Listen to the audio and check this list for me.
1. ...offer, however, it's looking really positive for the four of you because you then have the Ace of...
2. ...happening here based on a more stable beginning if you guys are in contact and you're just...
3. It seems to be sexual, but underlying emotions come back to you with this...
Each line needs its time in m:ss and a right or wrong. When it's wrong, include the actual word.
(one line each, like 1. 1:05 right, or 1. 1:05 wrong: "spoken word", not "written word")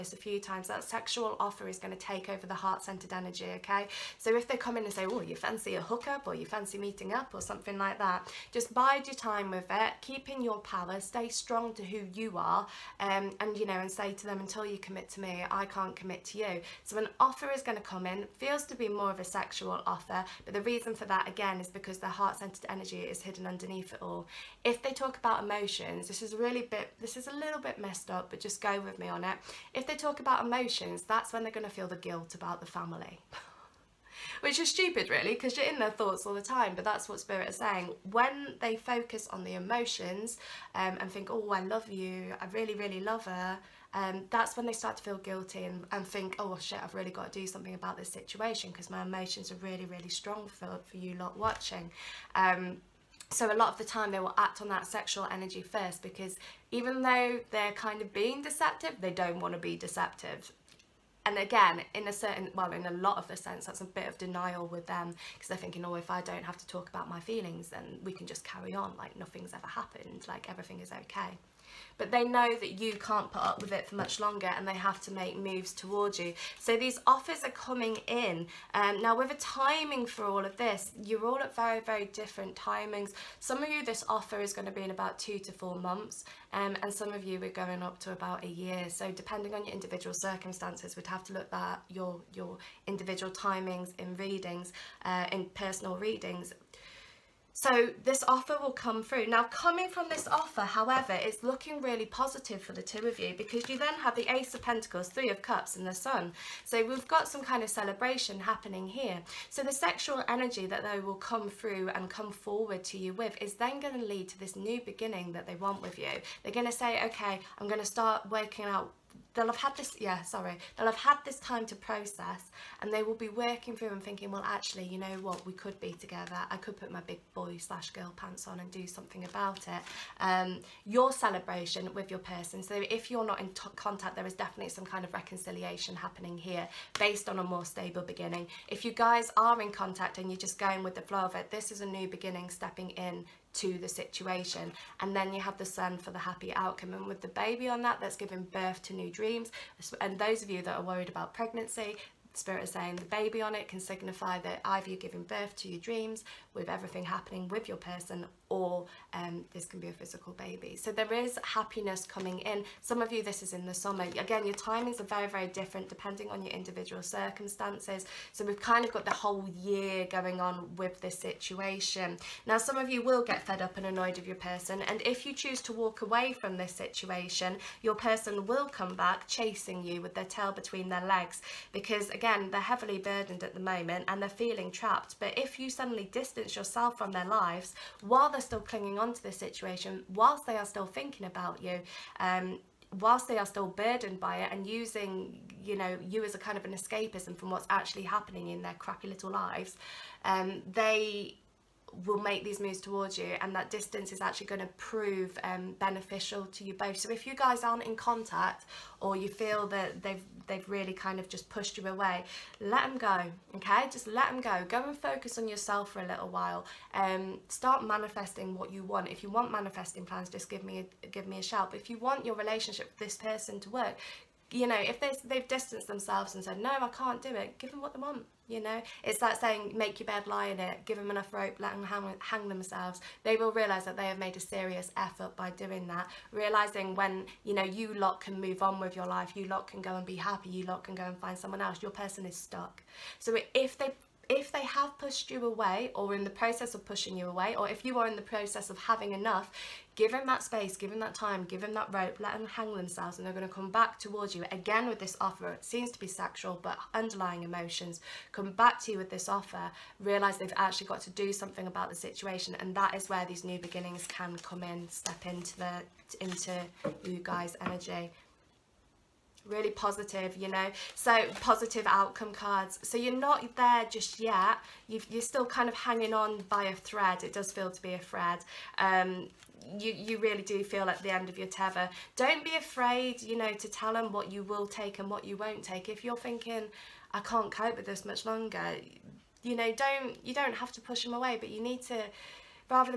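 1. 1:40 wrong: "two", not "four"
2. 2:15 right
3. 4:15 right.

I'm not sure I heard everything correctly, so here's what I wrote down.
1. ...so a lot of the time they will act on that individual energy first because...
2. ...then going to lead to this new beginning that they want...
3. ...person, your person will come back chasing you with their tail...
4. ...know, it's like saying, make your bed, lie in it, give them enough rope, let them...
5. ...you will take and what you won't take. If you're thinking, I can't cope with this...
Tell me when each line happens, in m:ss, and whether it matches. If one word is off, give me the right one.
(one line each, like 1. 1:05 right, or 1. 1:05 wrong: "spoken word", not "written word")
1. 0:53 wrong: "sexual", not "individual"
2. 1:53 right
3. 2:56 wrong: "situation", not "person"
4. 3:48 right
5. 4:44 right.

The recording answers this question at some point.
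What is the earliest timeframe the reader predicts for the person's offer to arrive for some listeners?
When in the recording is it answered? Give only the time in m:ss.
1:25.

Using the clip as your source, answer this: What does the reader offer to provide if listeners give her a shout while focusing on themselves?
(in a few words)
manifesting plans.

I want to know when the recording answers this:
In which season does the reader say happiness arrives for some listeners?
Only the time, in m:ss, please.
2:43.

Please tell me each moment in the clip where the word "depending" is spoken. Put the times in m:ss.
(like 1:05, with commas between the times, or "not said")
1:29, 2:45.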